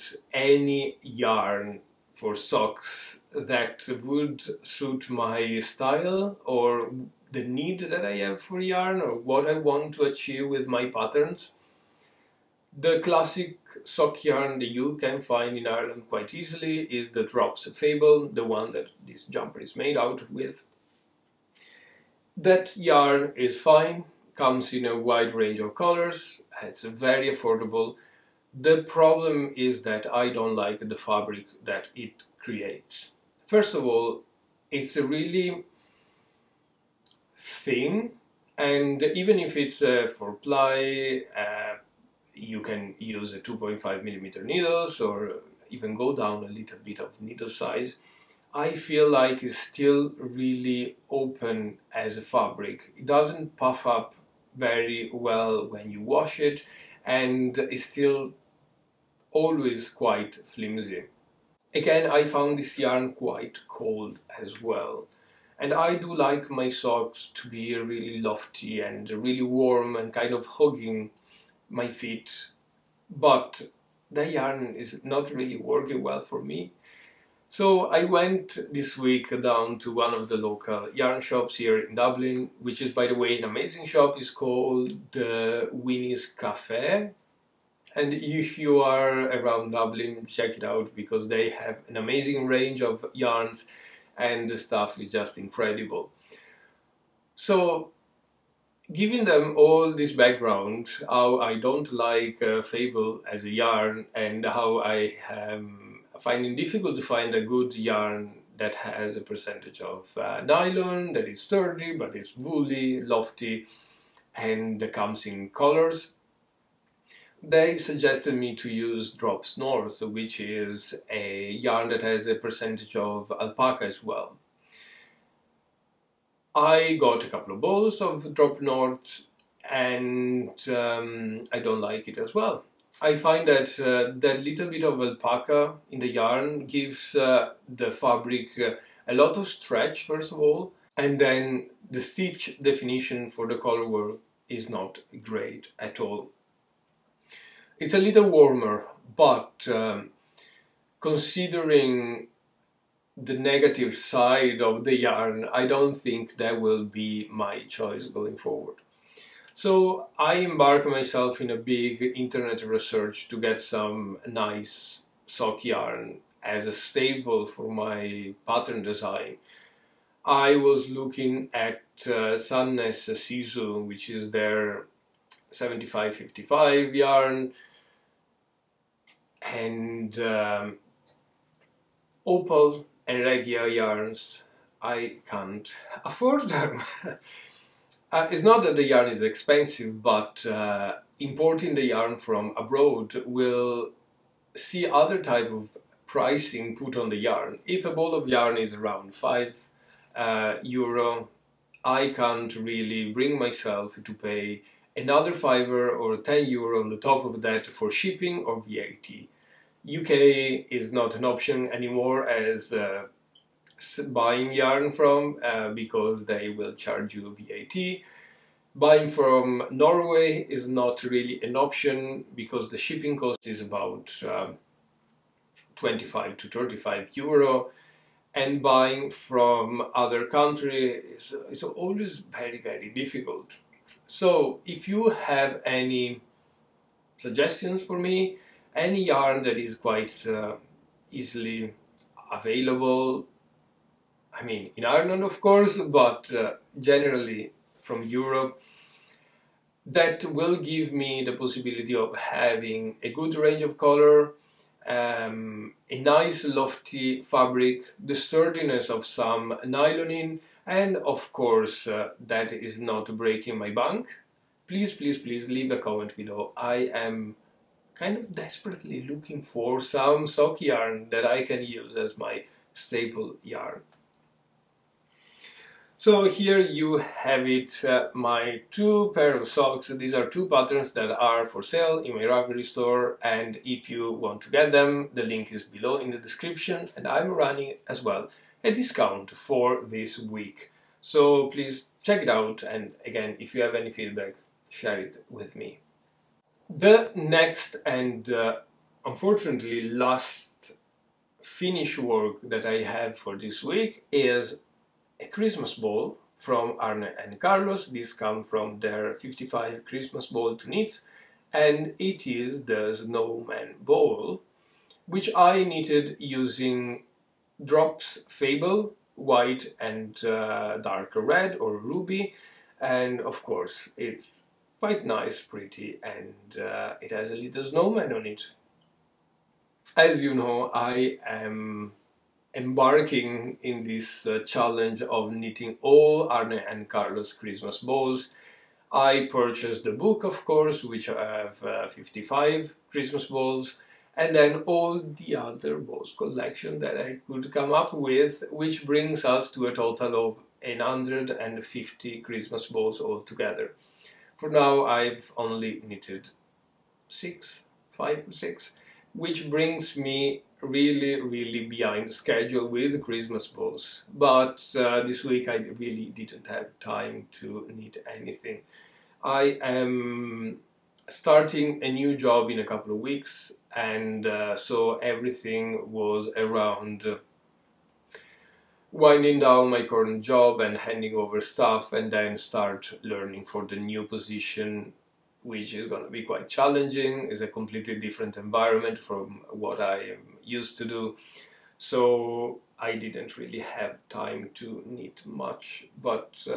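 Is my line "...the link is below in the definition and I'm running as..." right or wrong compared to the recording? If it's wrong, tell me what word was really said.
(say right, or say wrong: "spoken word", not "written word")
wrong: "description", not "definition".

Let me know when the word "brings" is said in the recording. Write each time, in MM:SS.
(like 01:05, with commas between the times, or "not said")
03:23, 05:48, 05:59.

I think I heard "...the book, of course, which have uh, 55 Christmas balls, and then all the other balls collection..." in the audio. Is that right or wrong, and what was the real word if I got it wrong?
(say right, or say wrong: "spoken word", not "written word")
right.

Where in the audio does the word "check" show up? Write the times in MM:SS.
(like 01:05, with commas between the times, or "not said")
01:30, 04:52.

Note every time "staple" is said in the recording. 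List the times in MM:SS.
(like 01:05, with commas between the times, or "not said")
02:46, 04:32.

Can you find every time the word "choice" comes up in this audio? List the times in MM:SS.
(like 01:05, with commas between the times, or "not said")
02:37.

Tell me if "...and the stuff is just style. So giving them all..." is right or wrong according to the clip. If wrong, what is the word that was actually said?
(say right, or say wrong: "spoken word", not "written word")
wrong: "incredible", not "style".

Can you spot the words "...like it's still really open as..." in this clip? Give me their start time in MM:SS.
00:49.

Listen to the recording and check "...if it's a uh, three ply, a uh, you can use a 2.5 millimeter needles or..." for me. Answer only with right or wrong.
wrong.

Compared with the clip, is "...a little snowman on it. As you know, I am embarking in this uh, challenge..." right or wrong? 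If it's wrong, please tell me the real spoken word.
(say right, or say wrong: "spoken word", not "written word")
right.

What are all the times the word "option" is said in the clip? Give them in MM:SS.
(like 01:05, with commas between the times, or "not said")
03:31, 03:41.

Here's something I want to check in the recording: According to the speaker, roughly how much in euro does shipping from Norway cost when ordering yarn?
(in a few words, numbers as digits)
25 to 35 euro.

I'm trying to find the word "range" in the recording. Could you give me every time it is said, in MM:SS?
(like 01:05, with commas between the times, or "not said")
00:25, 01:32, 04:13.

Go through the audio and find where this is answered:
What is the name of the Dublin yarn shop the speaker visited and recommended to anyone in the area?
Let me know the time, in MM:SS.
01:25.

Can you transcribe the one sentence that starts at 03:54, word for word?
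So if you have any suggestions for me, any yarn that is quite uh, easily available.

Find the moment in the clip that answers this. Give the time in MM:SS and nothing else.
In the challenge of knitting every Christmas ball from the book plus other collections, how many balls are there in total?
05:50.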